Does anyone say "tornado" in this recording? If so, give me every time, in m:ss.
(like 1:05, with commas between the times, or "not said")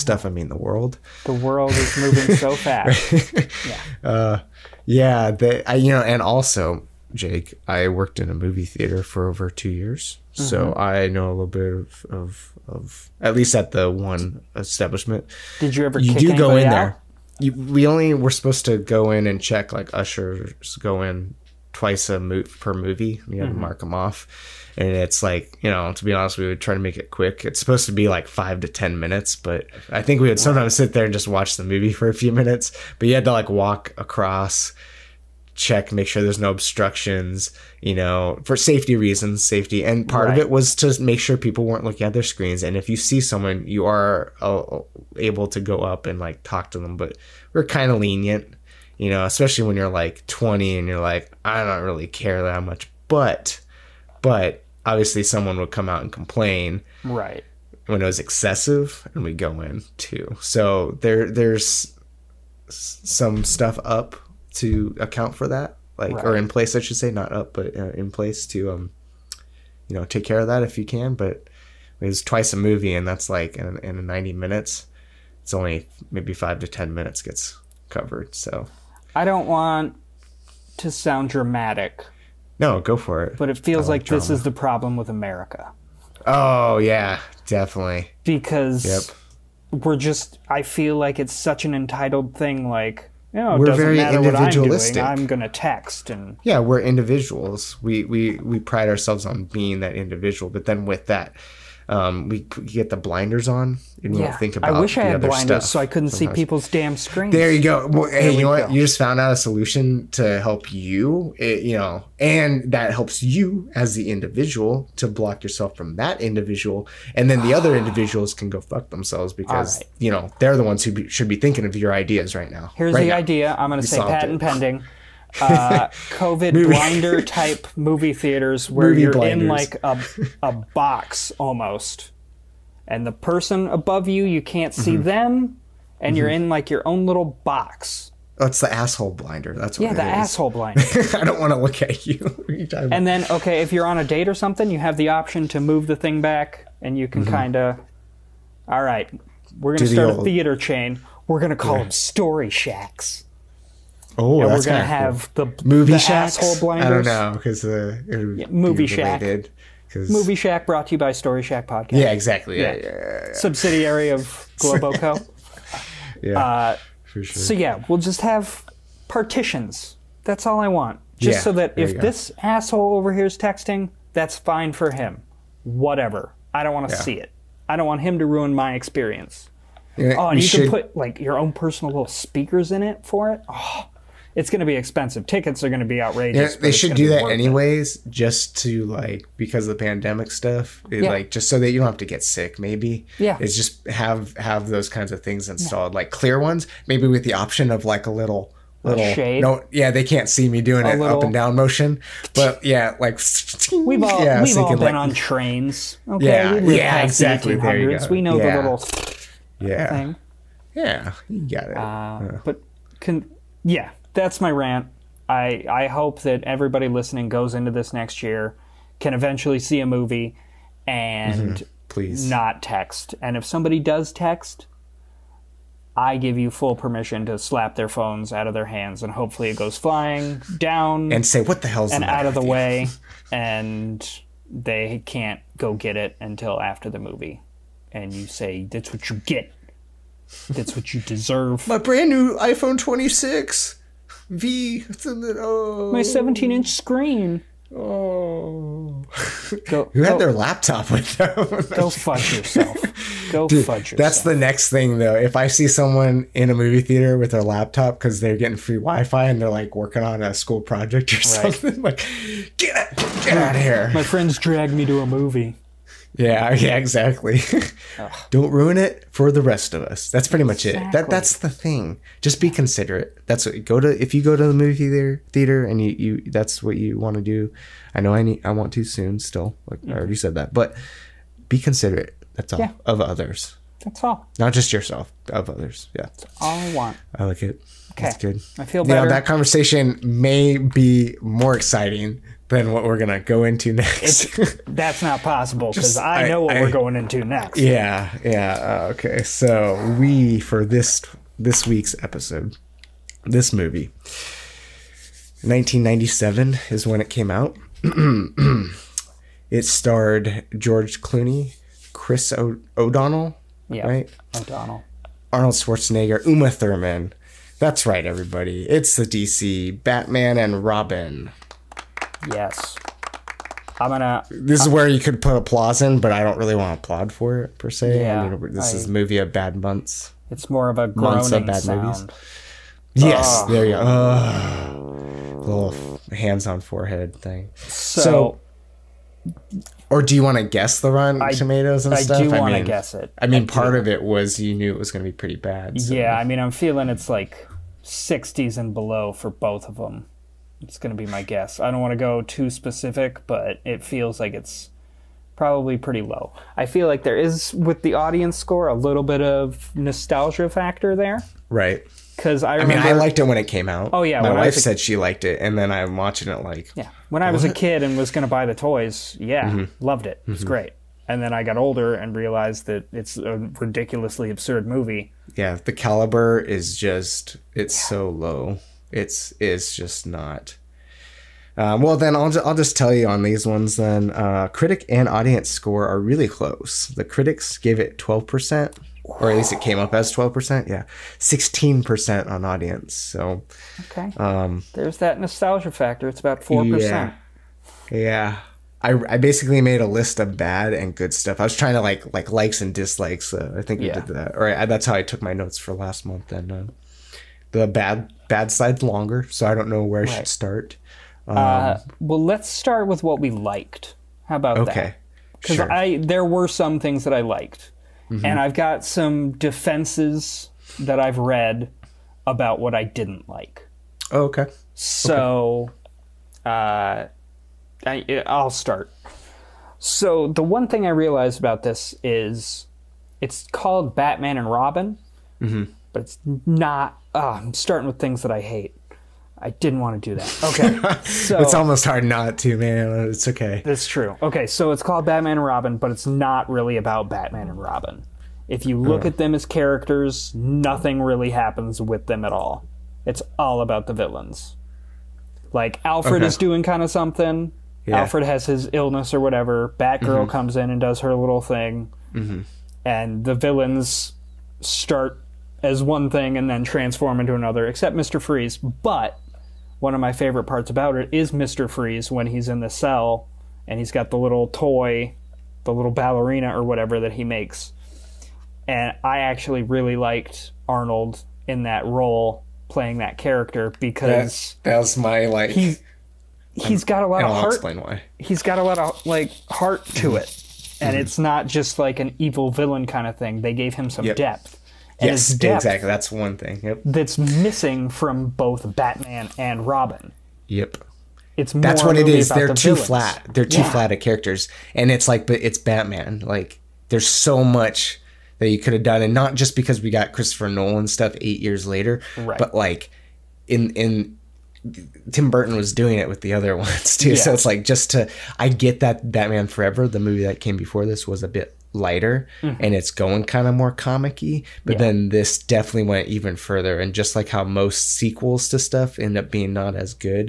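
not said.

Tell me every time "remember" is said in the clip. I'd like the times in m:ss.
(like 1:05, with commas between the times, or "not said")
6:02.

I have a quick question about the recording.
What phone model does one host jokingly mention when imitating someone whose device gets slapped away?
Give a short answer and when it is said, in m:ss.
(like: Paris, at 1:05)
iPhone 26, at 4:02.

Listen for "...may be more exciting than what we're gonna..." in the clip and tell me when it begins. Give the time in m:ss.
4:50.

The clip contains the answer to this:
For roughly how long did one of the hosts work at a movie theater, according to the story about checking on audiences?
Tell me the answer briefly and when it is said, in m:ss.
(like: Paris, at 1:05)
over two years, at 0:09.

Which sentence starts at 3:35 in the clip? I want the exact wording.
I I hope that everybody listening goes into this next year, can eventually see a movie, and mm-hmm.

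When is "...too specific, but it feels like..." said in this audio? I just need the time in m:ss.
5:52.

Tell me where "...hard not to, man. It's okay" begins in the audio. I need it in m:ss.
7:21.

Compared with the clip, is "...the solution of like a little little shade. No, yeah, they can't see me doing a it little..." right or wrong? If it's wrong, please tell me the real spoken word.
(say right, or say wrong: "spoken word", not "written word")
wrong: "option", not "solution".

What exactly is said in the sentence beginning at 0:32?
But you had to like walk across check, make sure there's no obstructions, you know, for safety reasons, safety.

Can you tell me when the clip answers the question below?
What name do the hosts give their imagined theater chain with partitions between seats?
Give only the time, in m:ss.
2:31.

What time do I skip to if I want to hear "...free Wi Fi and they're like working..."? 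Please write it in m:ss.
4:18.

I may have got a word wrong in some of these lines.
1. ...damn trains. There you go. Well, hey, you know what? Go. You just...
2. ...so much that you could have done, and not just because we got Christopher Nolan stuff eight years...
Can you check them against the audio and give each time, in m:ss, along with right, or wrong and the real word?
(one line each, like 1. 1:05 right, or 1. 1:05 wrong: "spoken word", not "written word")
1. 1:46 wrong: "screens", not "trains"
2. 8:27 right.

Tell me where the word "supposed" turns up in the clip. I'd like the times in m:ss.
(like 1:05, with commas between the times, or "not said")
0:18, 0:27.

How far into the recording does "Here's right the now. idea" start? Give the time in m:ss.
2:02.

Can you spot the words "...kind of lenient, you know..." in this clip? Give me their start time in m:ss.
0:47.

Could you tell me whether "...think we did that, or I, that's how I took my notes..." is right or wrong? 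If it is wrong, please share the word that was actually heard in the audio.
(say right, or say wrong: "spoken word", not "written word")
right.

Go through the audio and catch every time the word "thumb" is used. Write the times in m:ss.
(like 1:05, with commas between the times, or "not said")
not said.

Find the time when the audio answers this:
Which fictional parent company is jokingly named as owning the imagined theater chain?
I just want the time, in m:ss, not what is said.
2:44.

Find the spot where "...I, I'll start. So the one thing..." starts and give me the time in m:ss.
7:07.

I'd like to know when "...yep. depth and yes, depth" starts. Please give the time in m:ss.
8:14.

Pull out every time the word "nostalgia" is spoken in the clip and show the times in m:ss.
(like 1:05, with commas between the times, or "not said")
5:59, 6:35.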